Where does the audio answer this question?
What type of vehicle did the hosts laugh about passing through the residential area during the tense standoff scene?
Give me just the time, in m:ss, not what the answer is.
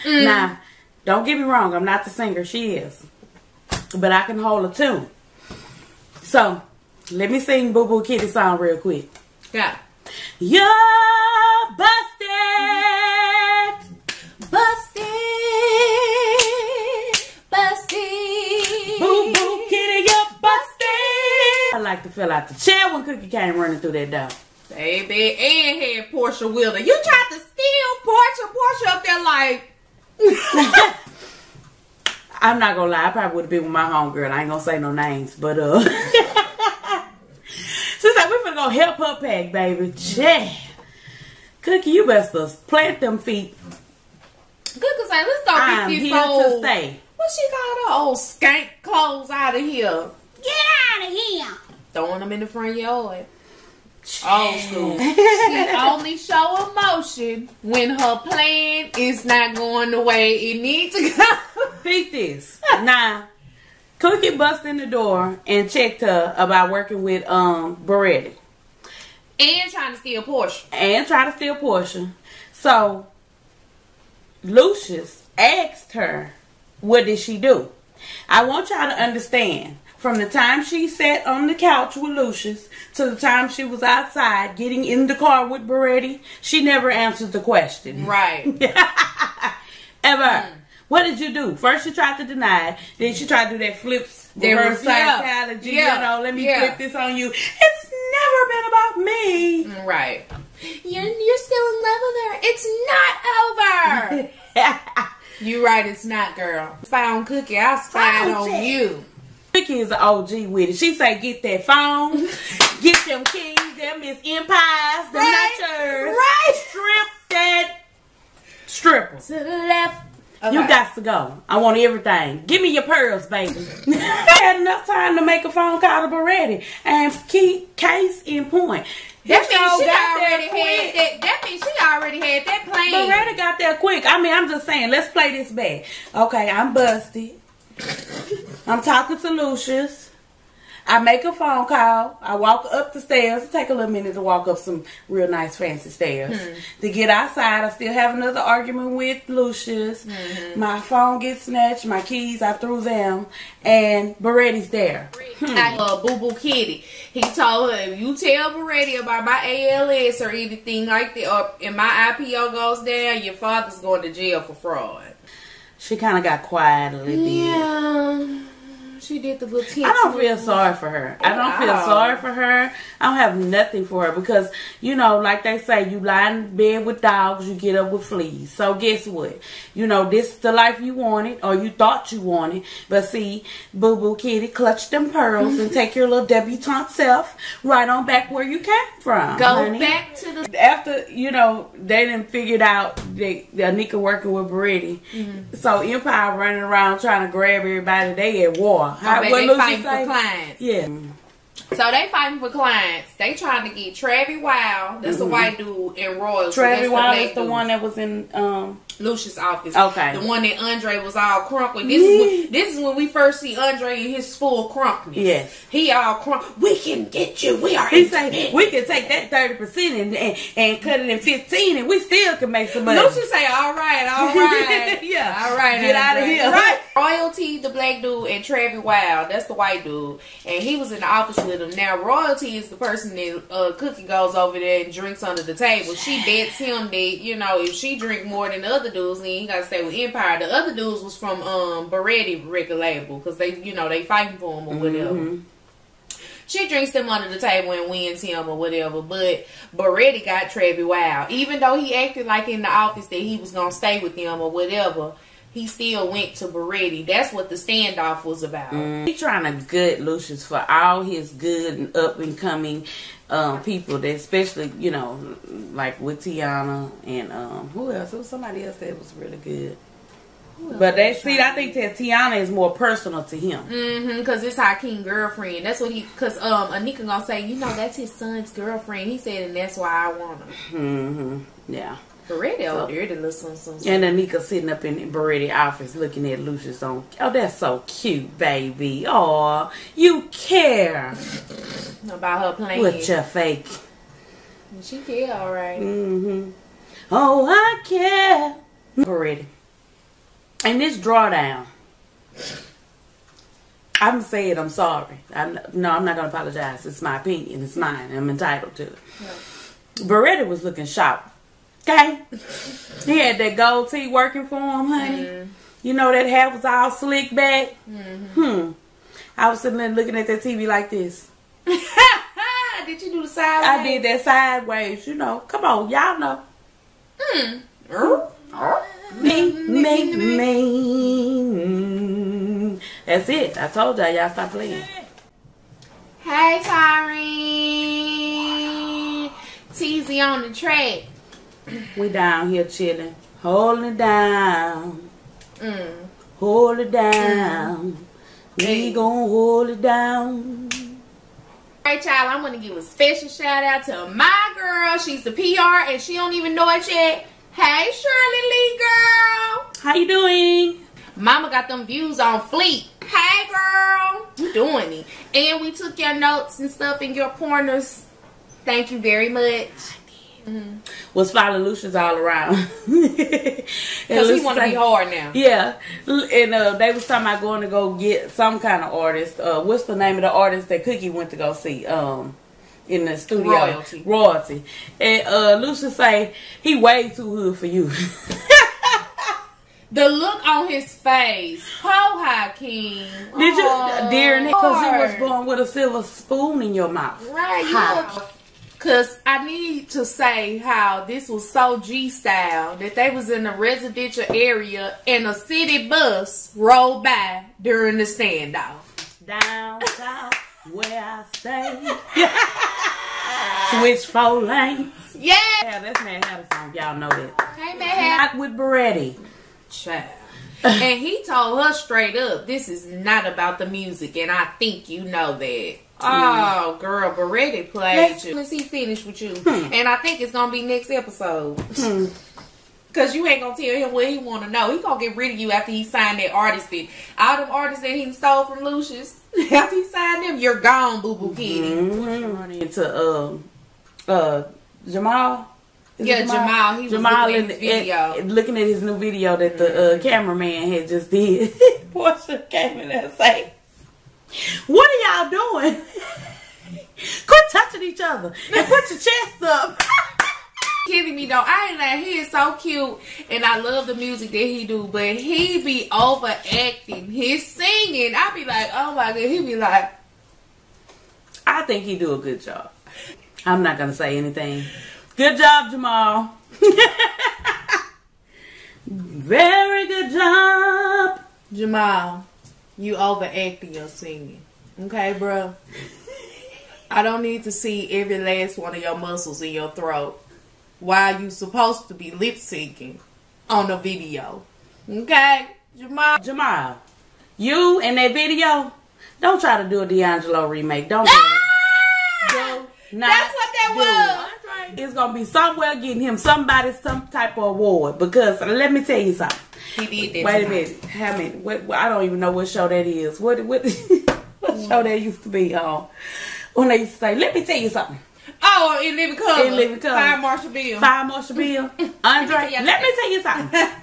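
6:45.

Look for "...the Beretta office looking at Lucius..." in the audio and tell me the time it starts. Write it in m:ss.
4:44.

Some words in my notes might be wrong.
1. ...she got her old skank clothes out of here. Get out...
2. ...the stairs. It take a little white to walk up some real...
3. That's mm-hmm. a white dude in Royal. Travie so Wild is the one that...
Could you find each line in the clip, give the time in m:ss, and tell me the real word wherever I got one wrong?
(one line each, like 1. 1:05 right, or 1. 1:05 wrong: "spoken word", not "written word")
1. 0:47 right
2. 2:22 wrong: "minute", not "white"
3. 3:25 right.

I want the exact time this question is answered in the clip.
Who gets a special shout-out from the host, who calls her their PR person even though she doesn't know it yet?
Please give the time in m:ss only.
5:57.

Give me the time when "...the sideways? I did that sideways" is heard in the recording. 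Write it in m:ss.
5:23.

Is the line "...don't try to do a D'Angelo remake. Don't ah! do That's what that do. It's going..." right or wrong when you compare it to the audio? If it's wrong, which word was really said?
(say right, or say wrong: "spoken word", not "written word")
right.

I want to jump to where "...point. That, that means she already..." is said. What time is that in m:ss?
2:08.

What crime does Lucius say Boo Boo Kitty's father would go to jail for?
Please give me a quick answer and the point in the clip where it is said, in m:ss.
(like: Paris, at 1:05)
fraud, at 2:44.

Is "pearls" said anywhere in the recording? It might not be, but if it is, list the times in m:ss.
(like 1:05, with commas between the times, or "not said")
2:02, 3:05.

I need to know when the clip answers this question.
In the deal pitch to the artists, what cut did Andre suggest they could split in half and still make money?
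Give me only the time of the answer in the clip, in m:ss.
3:39.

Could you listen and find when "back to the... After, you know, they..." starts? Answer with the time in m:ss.
3:09.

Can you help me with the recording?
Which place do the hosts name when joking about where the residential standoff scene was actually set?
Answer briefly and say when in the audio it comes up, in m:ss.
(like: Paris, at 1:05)
Manhattan, at 6:56.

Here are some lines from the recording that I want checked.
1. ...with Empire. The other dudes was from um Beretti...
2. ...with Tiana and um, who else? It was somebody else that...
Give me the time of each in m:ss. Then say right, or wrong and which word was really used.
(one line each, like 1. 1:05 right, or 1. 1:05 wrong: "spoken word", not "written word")
1. 3:59 right
2. 4:25 right.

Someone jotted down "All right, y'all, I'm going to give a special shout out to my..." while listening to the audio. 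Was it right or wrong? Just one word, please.
right.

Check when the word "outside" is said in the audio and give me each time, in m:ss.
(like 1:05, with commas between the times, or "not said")
1:23, 2:27.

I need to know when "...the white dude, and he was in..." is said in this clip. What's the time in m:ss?
3:49.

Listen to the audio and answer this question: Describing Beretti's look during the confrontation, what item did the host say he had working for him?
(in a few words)
gold tee.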